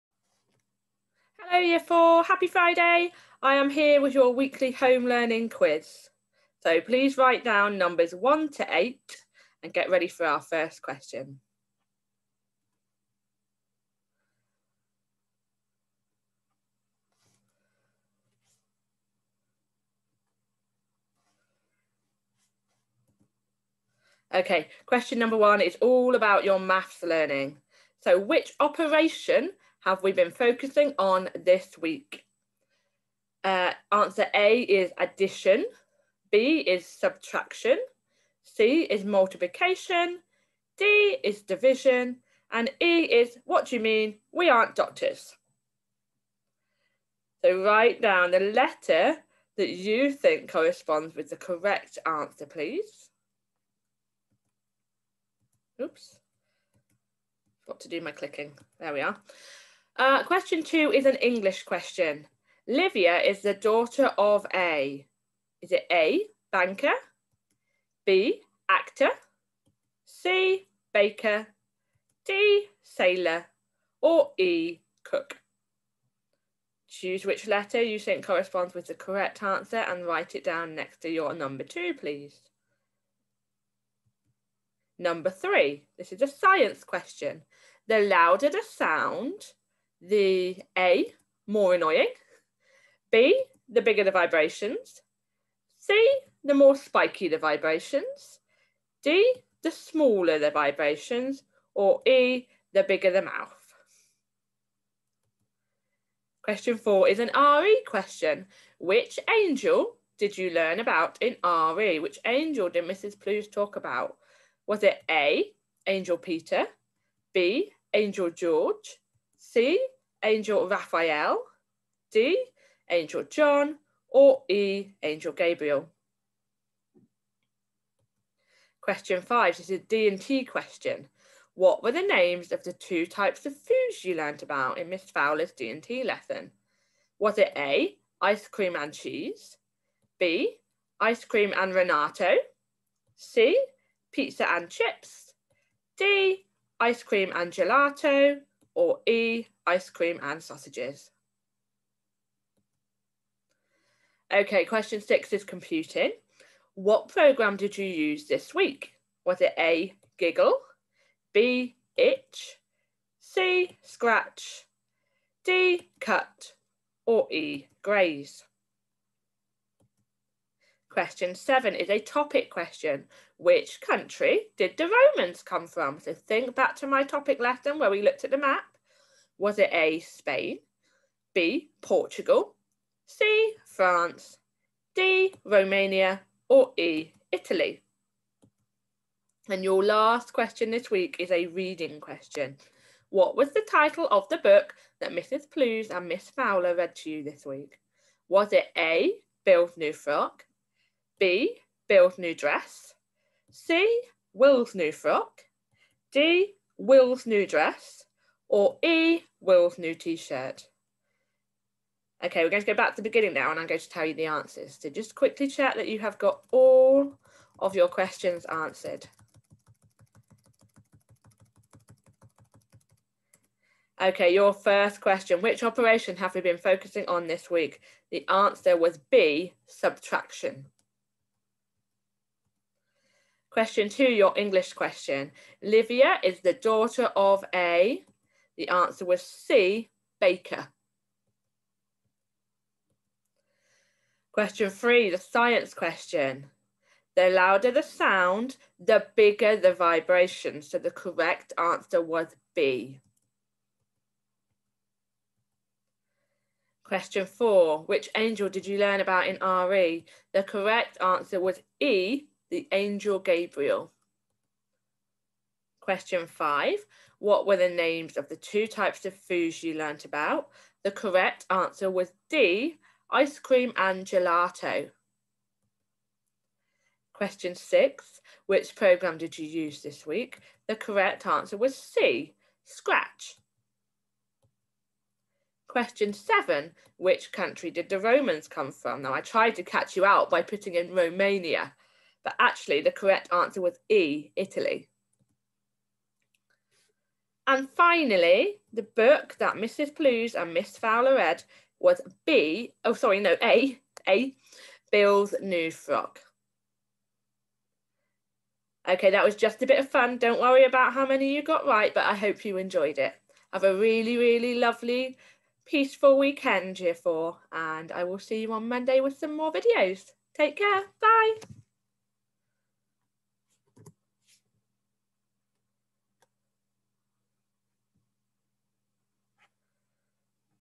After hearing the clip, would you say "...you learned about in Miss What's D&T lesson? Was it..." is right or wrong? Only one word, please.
wrong.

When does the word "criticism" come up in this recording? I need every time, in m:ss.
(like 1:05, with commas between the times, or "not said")
not said.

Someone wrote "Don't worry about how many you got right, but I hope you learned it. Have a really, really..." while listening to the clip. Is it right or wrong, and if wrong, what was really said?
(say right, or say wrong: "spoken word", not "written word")
wrong: "enjoyed", not "learned".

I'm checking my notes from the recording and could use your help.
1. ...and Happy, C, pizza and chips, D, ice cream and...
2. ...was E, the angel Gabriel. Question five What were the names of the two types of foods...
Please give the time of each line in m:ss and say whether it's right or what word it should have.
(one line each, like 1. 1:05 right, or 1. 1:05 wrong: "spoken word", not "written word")
1. 2:21 wrong: "Renato", not "Happy"
2. 4:21 right.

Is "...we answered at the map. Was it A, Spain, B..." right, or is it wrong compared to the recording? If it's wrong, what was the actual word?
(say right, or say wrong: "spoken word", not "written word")
wrong: "looked", not "answered".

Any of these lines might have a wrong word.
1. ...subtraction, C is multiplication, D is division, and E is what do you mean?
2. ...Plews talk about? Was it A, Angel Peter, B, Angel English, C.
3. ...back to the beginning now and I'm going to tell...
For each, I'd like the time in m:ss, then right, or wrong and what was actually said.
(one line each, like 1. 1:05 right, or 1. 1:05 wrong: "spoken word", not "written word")
1. 0:36 right
2. 1:53 wrong: "George", not "English"
3. 3:32 right.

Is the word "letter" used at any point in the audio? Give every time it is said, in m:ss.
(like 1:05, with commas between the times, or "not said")
0:48, 1:17.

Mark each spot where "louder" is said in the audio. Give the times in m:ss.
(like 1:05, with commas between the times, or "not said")
1:27, 4:07.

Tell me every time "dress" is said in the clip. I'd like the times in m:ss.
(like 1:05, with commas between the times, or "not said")
3:22, 3:27.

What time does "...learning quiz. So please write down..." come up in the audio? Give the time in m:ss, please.
0:05.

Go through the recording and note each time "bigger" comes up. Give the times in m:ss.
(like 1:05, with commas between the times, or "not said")
1:33, 1:42, 4:09.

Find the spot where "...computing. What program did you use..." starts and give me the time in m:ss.
2:35.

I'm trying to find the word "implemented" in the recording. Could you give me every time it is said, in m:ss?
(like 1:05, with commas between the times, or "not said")
not said.